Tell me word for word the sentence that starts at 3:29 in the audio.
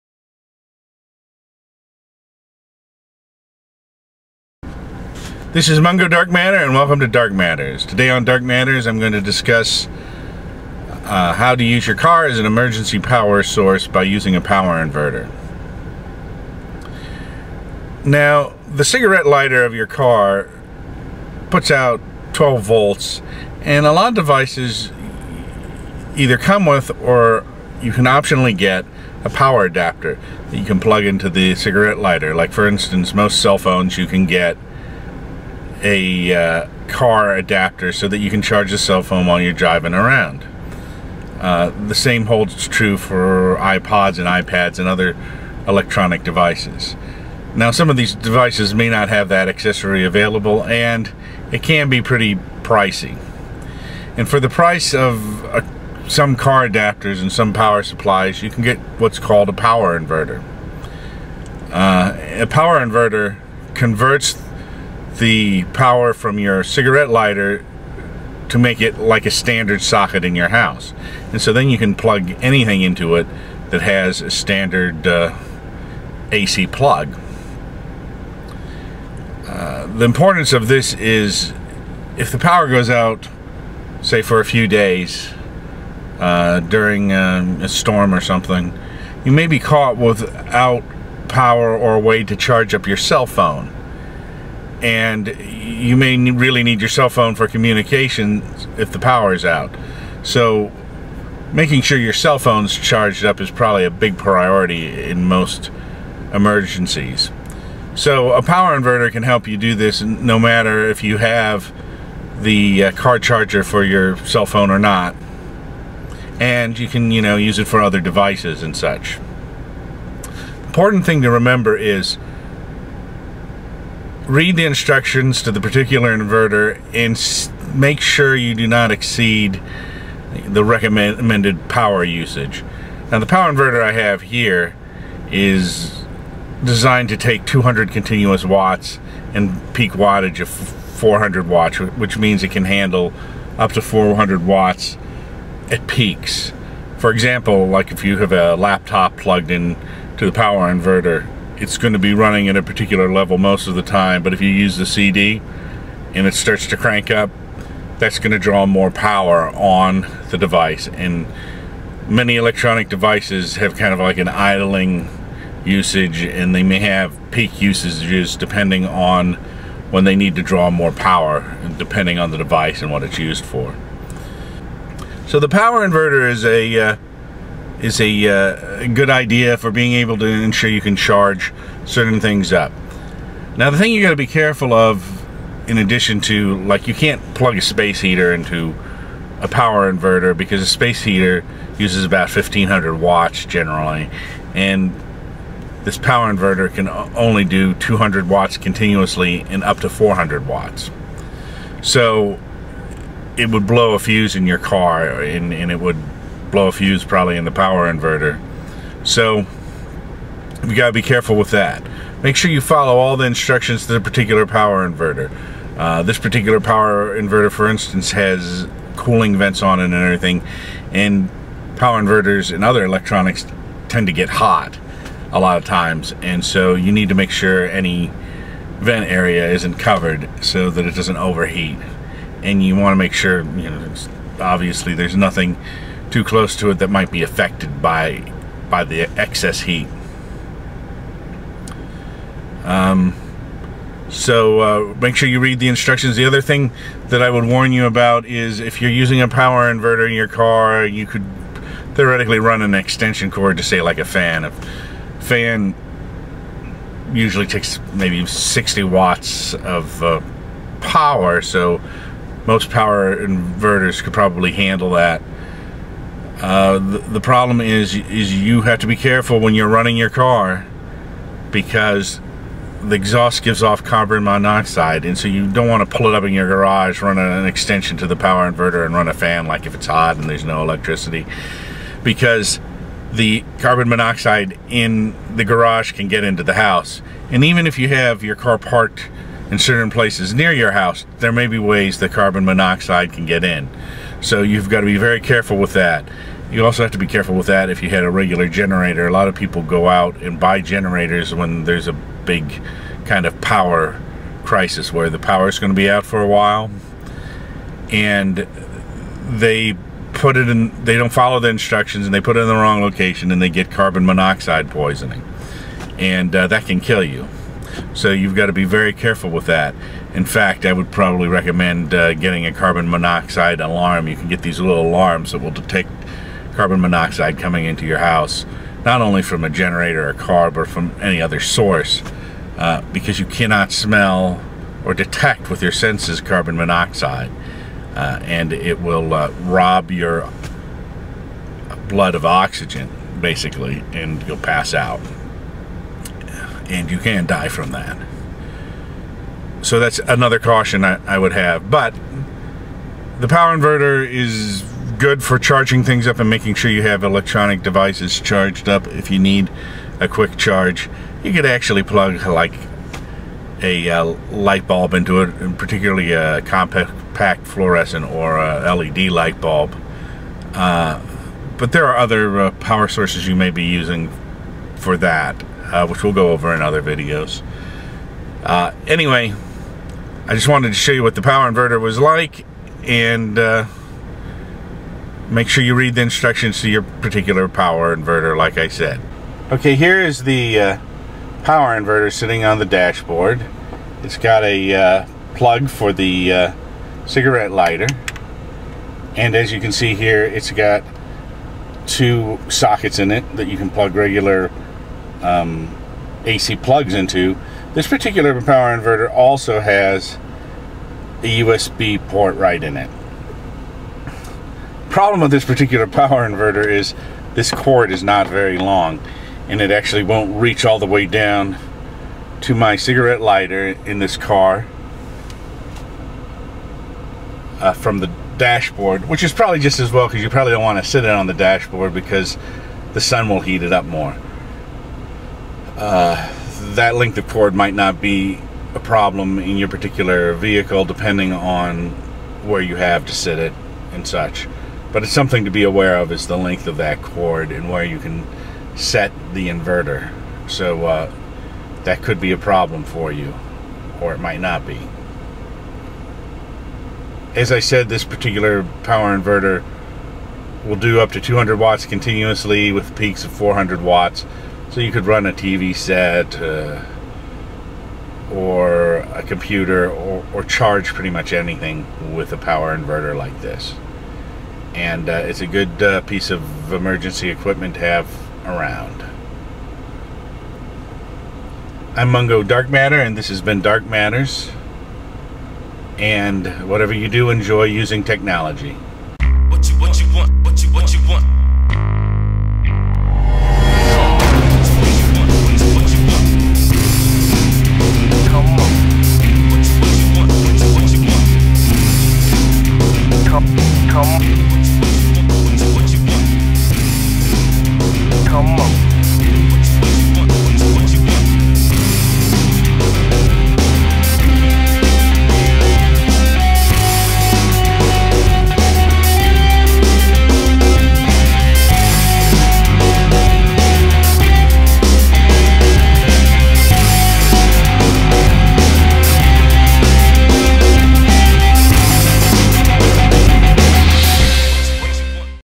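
So you gotta be careful with that.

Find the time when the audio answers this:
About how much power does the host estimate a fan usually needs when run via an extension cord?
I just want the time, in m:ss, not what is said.
4:18.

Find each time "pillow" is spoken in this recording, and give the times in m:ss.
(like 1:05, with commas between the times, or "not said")
not said.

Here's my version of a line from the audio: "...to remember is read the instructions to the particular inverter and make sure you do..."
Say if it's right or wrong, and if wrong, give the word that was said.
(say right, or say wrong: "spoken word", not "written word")
right.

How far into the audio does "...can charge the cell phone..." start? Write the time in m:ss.
0:38.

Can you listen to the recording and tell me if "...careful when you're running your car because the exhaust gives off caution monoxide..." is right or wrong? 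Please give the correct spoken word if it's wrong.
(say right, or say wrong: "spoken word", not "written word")
wrong: "carbon", not "caution".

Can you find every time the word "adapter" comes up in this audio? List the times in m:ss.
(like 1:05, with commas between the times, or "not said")
0:29, 0:37, 0:56.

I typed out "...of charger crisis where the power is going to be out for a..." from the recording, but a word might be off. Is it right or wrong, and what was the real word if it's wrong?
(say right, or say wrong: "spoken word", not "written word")
wrong: "power", not "charger".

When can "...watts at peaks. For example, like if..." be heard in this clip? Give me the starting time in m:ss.
2:24.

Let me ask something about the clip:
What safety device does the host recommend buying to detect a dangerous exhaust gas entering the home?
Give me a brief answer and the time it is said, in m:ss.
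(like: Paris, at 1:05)
carbon monoxide alarm, at 5:22.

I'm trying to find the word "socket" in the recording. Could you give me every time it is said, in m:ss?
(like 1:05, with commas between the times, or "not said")
1:09, 6:42.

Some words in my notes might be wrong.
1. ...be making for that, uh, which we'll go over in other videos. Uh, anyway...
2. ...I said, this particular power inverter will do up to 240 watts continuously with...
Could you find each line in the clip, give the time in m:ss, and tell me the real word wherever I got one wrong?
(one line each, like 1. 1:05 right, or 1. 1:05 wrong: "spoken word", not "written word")
1. 6:13 wrong: "using", not "making"
2. 7:37 wrong: "200", not "240".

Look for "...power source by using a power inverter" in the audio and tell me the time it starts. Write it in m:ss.
0:12.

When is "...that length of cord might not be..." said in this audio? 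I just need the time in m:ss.
7:16.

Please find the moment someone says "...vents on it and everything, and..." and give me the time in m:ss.
3:39.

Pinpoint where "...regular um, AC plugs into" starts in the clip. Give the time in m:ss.
6:43.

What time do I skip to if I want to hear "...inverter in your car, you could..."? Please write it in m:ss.
4:09.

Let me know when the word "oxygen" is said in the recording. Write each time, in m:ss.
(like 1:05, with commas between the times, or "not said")
5:42.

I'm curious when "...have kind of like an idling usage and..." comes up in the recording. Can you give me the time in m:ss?
2:43.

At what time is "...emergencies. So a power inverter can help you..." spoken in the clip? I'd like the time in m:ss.
1:46.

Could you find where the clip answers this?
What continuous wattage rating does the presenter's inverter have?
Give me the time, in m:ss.
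2:17.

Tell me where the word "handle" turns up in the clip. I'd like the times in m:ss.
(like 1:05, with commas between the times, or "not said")
2:22, 4:24.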